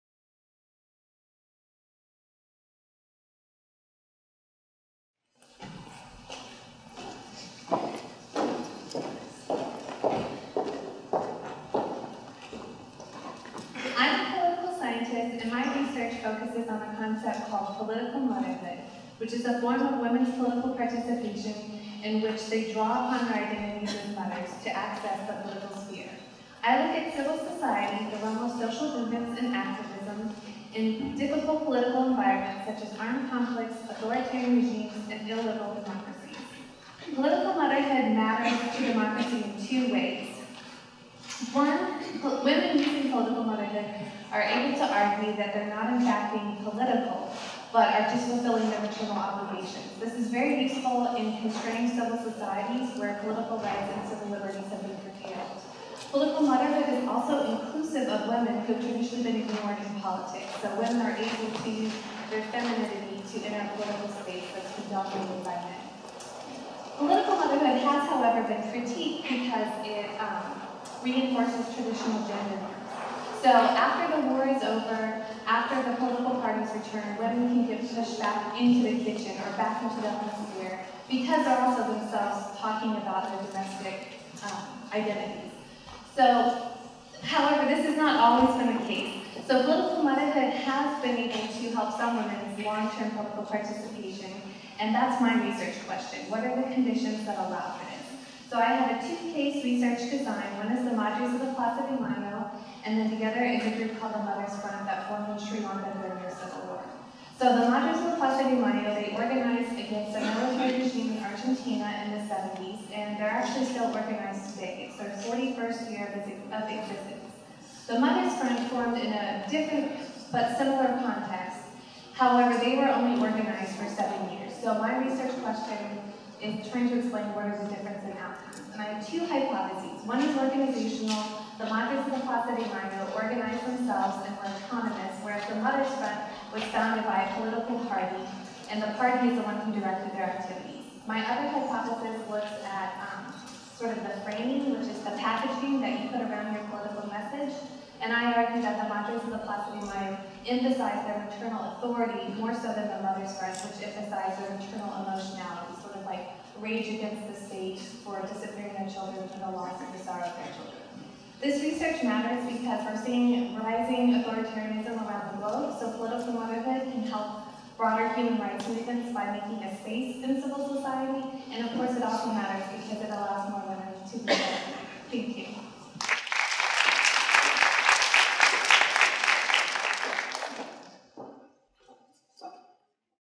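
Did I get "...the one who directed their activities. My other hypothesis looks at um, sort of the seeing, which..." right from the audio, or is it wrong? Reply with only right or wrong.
wrong.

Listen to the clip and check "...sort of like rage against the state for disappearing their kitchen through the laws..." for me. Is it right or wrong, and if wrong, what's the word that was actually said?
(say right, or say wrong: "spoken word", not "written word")
wrong: "children", not "kitchen".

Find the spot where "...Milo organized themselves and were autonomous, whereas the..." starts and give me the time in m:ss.
2:12.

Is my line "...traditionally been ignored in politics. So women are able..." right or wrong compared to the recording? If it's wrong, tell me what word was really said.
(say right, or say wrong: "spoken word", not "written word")
right.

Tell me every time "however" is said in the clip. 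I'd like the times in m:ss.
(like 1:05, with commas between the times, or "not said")
1:08, 1:27, 2:02.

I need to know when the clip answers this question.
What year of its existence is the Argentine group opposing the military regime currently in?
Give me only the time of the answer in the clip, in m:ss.
1:55.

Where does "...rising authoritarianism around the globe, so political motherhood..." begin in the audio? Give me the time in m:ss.
2:43.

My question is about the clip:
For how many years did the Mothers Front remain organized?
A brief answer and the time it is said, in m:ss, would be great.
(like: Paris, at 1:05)
7, at 2:03.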